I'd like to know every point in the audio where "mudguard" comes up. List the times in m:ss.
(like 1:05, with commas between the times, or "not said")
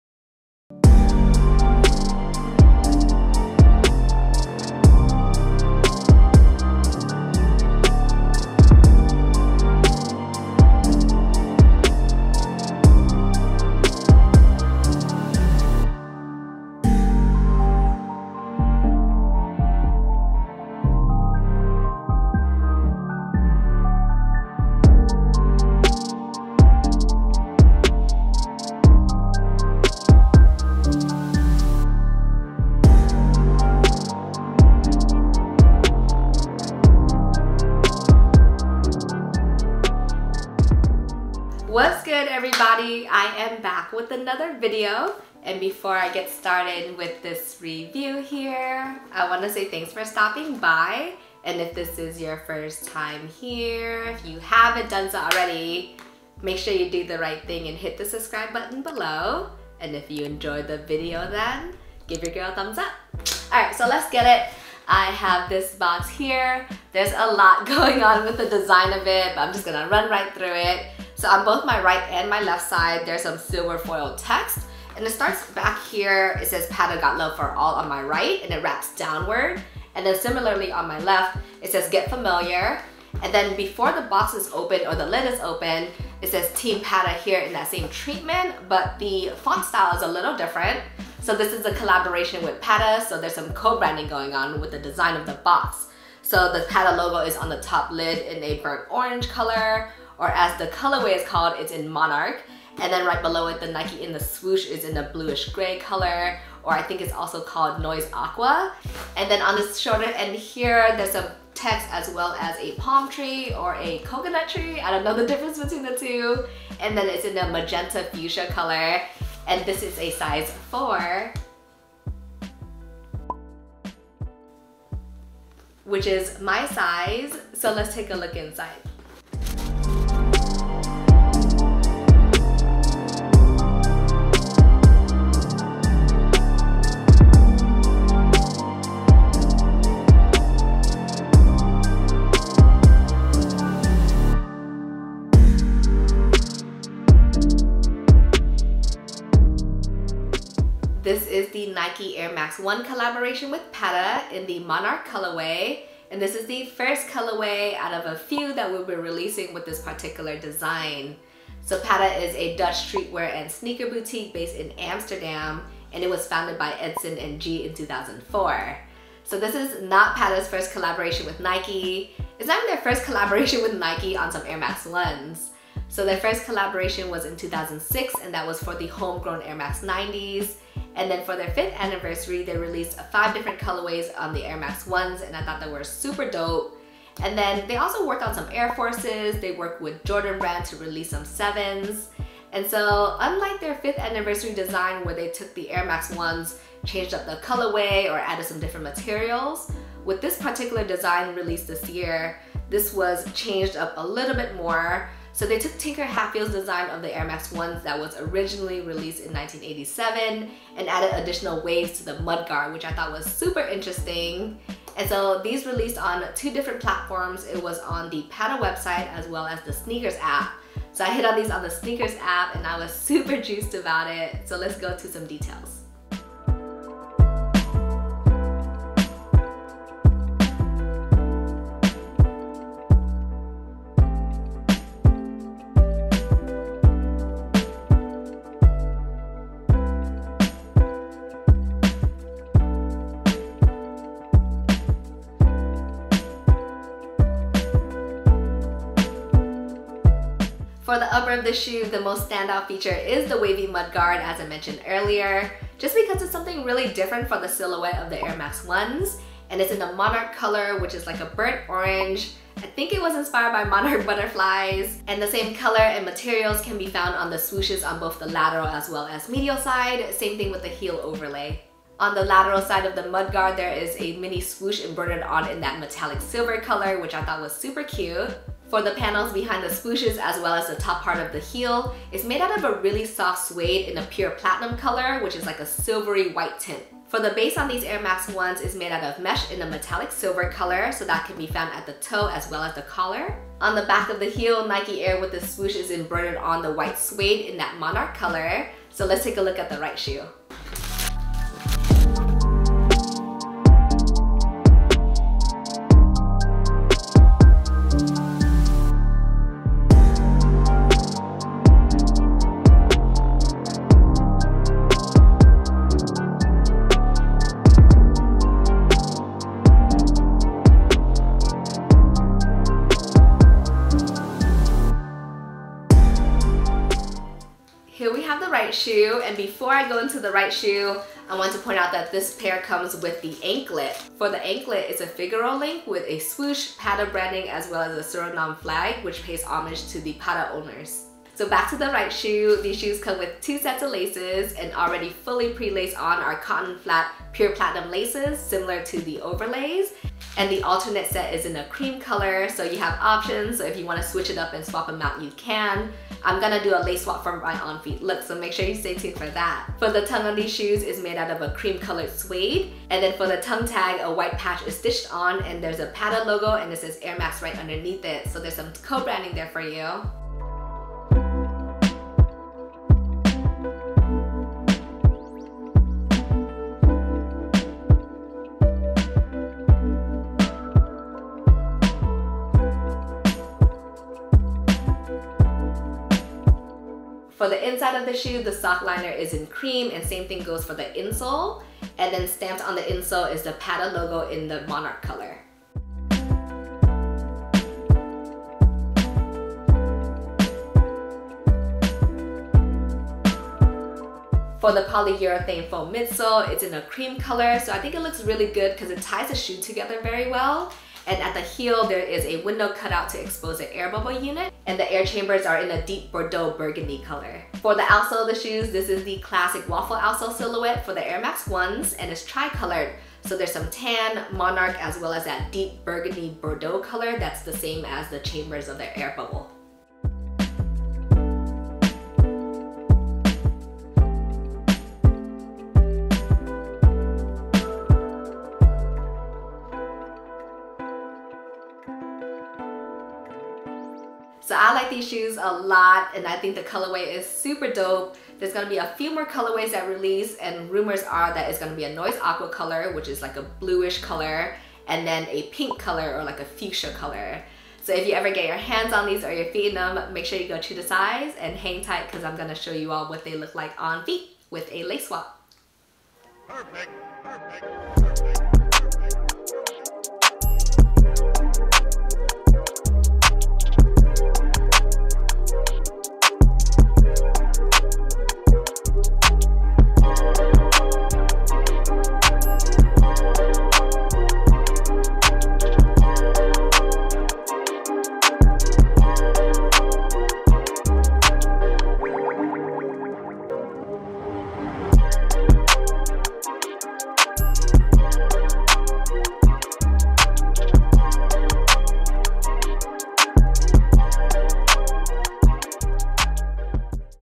3:32, 4:13, 4:33.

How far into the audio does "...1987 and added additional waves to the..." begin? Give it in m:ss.
3:29.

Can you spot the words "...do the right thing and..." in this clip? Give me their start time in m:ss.
0:56.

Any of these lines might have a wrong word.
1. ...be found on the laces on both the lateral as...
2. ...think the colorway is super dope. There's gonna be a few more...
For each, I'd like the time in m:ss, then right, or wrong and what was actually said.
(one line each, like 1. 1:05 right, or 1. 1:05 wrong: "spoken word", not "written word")
1. 4:26 wrong: "swooshes", not "laces"
2. 7:26 right.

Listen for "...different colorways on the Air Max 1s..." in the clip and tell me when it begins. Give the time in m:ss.
3:03.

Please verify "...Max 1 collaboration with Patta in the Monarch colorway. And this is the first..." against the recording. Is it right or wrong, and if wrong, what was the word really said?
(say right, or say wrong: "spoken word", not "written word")
right.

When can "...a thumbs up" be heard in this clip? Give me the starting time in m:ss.
1:02.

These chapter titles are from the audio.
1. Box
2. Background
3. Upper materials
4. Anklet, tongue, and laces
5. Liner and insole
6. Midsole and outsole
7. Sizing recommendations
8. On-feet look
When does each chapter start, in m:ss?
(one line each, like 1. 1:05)
1. 1:03
2. 2:30
3. 4:10
4. 5:13
5. 6:27
6. 6:44
7. 7:23
8. 7:45.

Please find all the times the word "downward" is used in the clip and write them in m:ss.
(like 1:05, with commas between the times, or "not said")
1:18.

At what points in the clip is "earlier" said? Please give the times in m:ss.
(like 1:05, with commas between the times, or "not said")
4:14.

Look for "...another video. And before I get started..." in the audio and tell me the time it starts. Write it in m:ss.
0:44.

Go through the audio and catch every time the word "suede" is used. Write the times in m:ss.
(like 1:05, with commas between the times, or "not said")
4:43, 4:56, 6:02.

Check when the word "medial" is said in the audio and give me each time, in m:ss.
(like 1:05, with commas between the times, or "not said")
4:29.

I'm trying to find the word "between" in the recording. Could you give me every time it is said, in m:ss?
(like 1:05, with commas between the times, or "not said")
1:55.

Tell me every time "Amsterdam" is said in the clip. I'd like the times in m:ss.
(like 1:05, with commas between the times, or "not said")
2:44.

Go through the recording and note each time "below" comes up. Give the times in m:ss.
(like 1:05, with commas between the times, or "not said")
0:58, 1:43.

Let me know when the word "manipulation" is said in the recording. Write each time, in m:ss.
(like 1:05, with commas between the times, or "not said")
not said.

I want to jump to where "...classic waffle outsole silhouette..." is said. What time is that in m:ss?
6:59.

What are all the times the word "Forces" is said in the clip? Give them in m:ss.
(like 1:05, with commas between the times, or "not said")
3:08.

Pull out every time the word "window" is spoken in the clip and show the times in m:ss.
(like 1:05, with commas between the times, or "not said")
6:52.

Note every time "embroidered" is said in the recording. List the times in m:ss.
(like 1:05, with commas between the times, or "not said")
4:34, 4:55.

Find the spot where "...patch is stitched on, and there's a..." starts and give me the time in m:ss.
6:04.